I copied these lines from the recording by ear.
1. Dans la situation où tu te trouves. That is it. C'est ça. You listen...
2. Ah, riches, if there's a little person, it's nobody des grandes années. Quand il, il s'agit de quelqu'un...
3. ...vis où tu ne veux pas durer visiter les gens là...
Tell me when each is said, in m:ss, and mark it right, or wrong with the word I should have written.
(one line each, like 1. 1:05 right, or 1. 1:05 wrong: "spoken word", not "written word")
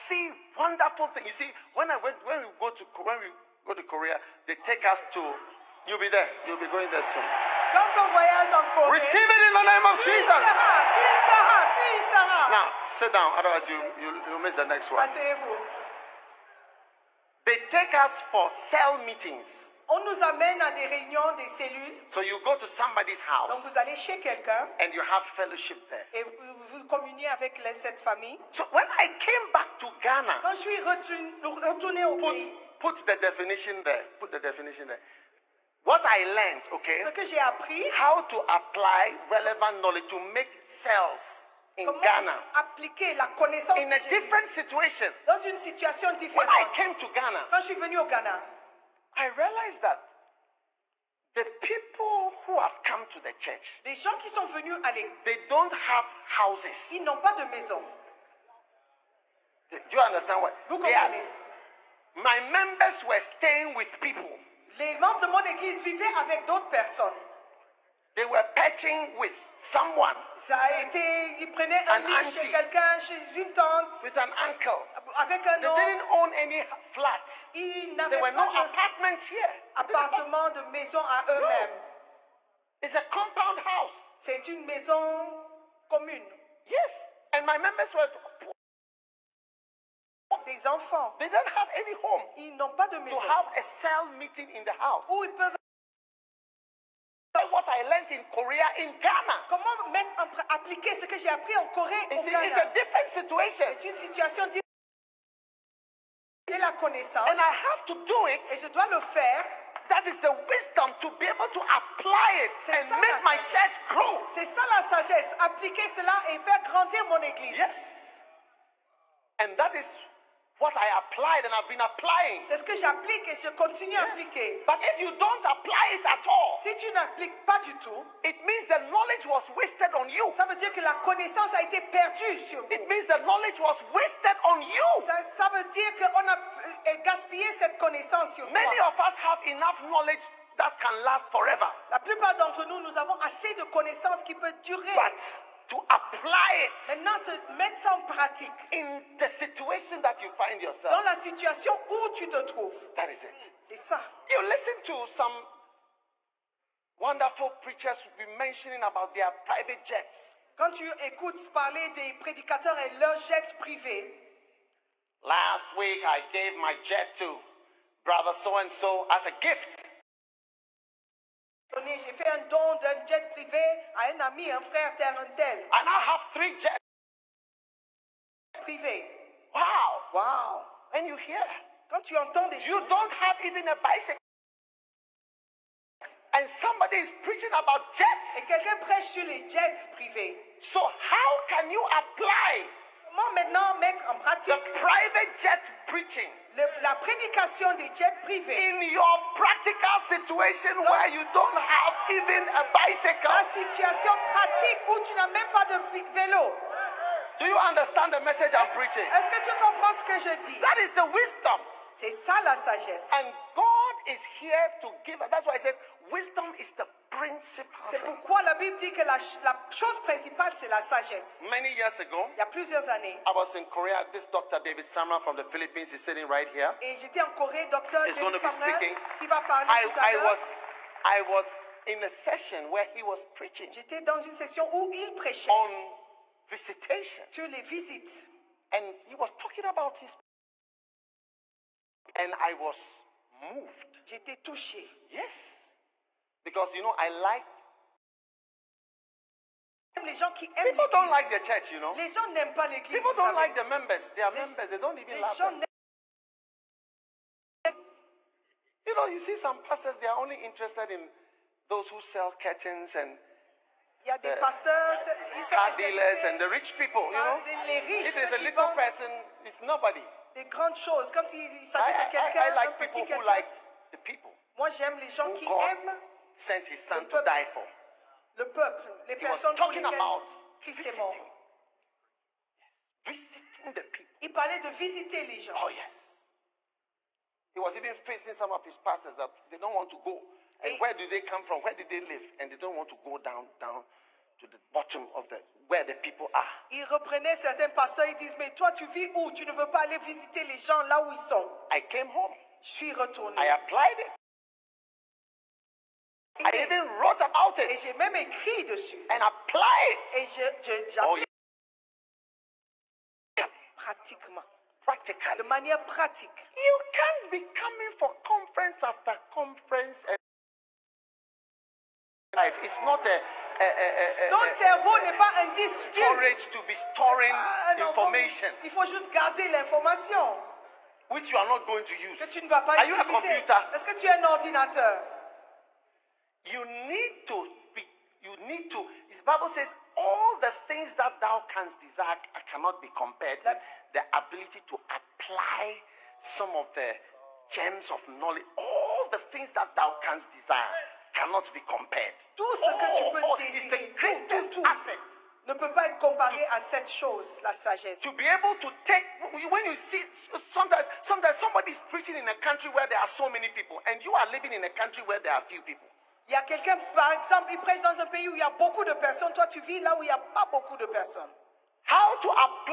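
1. 2:30 right
2. 4:27 wrong: "choses", not "années"
3. 4:58 wrong: "aller", not "durer".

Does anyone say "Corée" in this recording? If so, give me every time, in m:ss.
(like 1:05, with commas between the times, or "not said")
0:08, 1:41, 3:47.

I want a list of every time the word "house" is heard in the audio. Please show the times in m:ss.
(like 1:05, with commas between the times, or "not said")
0:23, 0:56, 1:23, 1:34.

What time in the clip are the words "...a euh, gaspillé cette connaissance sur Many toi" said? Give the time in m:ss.
2:16.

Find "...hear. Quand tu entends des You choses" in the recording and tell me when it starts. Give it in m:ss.
3:01.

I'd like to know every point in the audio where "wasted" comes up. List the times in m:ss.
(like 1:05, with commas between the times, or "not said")
2:09, 2:13.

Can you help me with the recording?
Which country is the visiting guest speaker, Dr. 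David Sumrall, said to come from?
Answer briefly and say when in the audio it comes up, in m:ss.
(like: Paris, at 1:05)
Philippines, at 3:45.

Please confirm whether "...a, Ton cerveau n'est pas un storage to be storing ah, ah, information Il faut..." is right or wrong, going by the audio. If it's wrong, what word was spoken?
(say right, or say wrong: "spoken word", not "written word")
right.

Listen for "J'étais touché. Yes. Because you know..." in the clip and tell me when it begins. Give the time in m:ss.
4:04.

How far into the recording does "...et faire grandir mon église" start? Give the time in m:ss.
1:56.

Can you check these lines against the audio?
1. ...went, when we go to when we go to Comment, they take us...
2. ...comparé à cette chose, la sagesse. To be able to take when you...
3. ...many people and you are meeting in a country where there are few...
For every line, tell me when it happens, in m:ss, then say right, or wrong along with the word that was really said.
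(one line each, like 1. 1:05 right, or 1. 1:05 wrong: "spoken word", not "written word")
1. 0:01 wrong: "Korea", not "Comment"
2. 5:55 right
3. 6:03 wrong: "living", not "meeting".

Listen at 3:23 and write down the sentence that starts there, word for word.
La situation pratique où tu n'as même pas de vélo.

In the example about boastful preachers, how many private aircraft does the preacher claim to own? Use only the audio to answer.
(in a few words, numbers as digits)
3.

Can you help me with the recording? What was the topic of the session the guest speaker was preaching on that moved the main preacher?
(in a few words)
visitation.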